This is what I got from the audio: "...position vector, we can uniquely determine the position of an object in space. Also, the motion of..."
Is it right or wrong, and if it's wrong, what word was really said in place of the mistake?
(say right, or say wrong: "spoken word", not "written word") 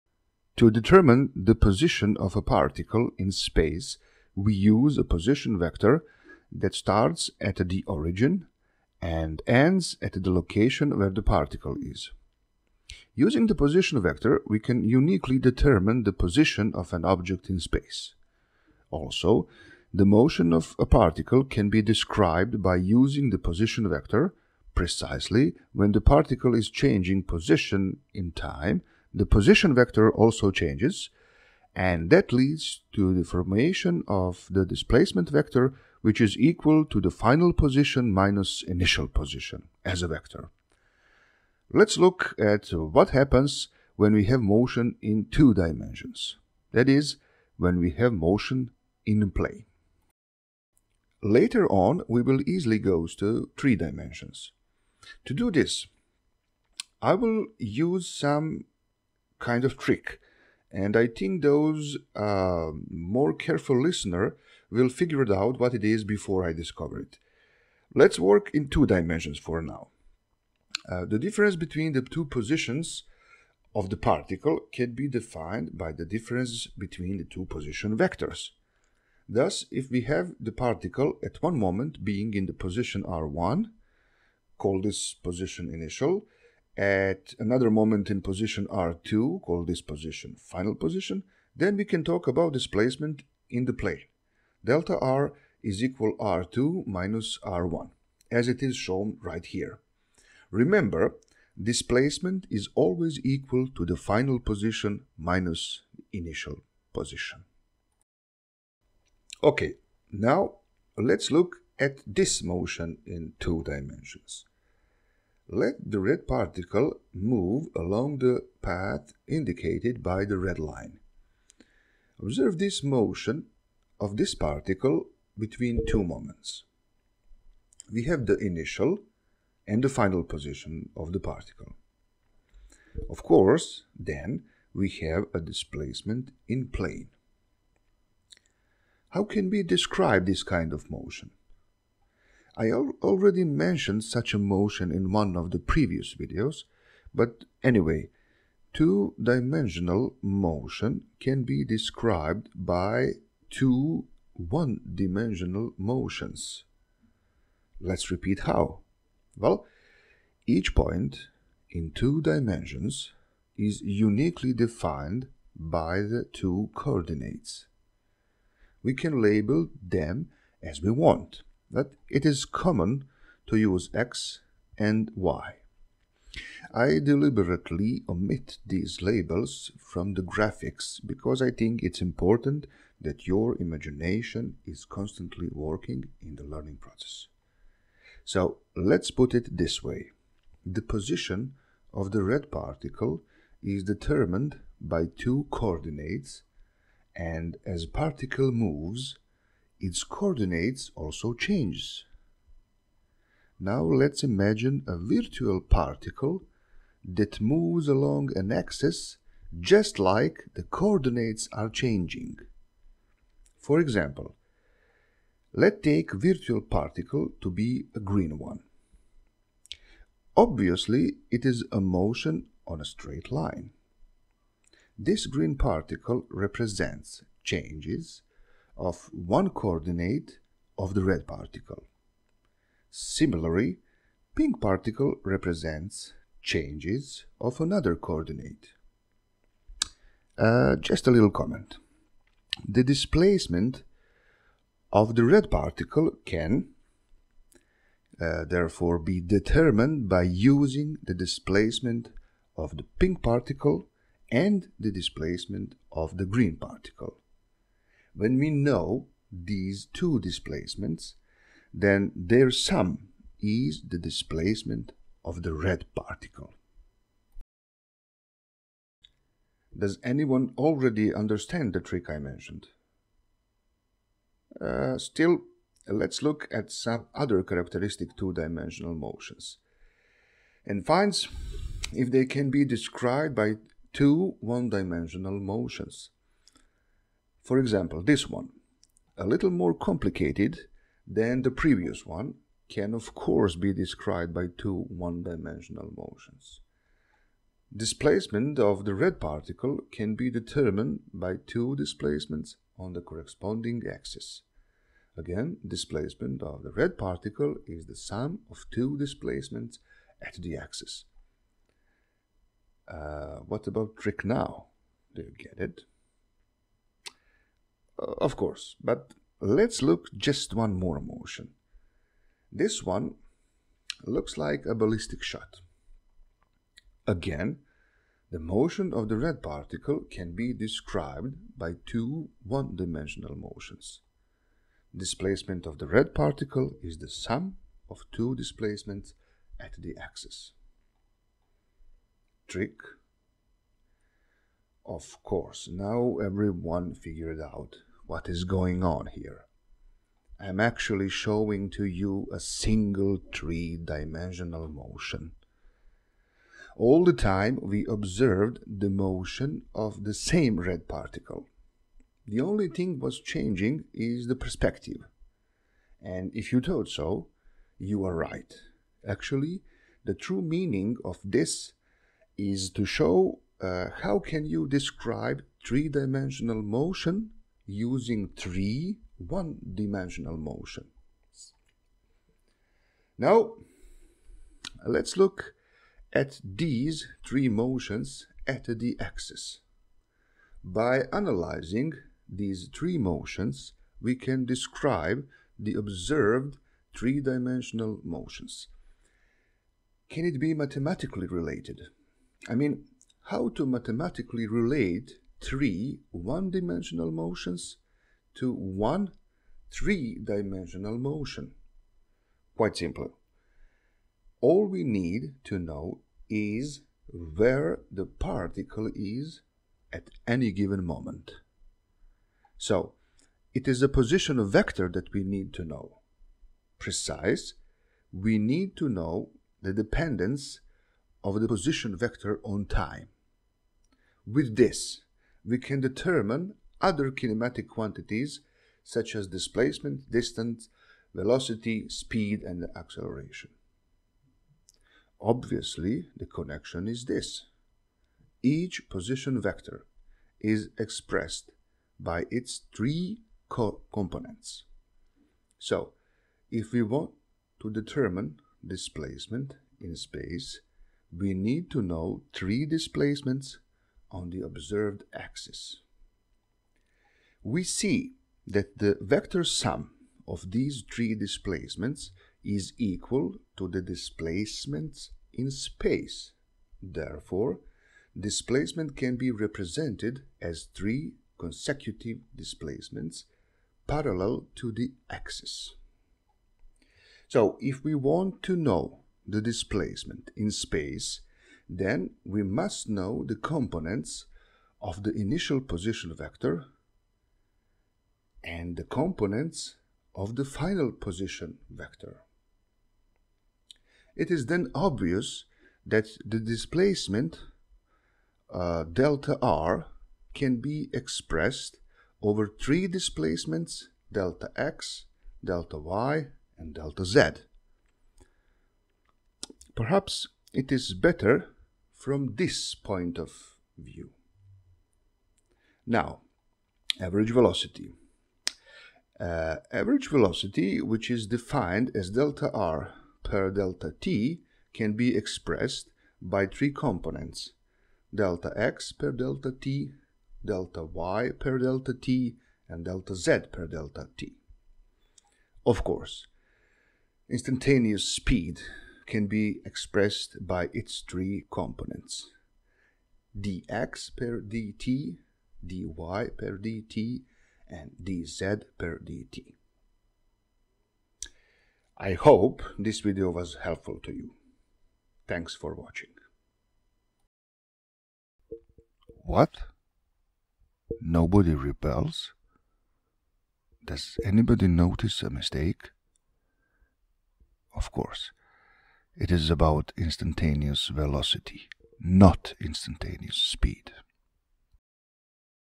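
right.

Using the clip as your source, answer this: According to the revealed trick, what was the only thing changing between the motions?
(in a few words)
the perspective.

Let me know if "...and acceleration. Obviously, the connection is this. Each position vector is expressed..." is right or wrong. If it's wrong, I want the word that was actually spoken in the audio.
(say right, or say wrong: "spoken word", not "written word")
right.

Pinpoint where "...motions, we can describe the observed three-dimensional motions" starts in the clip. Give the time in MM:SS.
06:32.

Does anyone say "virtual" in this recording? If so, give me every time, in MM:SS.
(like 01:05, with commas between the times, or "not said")
03:24, 03:36.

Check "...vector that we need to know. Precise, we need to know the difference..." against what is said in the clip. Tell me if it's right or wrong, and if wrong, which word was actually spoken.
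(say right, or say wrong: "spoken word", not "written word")
wrong: "dependence", not "difference".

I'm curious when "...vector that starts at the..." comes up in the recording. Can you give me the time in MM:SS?
00:05.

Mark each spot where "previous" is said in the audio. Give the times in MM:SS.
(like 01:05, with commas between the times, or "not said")
02:25, 04:51.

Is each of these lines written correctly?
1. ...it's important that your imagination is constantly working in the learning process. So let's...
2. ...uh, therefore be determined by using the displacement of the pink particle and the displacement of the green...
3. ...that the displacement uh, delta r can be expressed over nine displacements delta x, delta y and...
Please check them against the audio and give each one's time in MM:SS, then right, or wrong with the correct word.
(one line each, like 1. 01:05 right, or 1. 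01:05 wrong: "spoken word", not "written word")
1. 03:01 right
2. 04:08 right
3. 08:25 wrong: "three", not "nine".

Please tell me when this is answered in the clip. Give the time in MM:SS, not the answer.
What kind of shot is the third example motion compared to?
05:24.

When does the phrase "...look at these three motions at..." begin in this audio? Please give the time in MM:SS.
06:25.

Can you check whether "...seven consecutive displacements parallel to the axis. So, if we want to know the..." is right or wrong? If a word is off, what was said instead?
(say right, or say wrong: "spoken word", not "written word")
wrong: "three", not "seven".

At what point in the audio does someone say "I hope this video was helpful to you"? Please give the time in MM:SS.
09:22.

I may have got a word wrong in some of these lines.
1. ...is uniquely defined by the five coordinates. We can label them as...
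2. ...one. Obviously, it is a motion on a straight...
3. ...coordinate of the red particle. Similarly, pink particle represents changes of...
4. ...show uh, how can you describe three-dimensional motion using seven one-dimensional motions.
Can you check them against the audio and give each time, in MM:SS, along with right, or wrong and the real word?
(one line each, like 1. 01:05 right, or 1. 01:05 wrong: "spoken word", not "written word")
1. 02:43 wrong: "two", not "five"
2. 03:38 right
3. 03:49 right
4. 06:12 wrong: "three", not "seven".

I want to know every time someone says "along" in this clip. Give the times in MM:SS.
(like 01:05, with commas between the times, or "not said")
01:57, 03:27.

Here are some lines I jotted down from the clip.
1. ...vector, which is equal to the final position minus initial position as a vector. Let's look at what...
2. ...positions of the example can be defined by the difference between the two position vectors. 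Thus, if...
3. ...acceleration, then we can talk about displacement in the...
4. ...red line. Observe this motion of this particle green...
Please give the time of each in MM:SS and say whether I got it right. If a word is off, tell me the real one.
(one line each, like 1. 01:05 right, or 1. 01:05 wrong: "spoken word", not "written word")
1. 00:35 right
2. 01:12 wrong: "particle", not "example"
3. 01:30 wrong: "position", not "acceleration"
4. 02:00 wrong: "between", not "green".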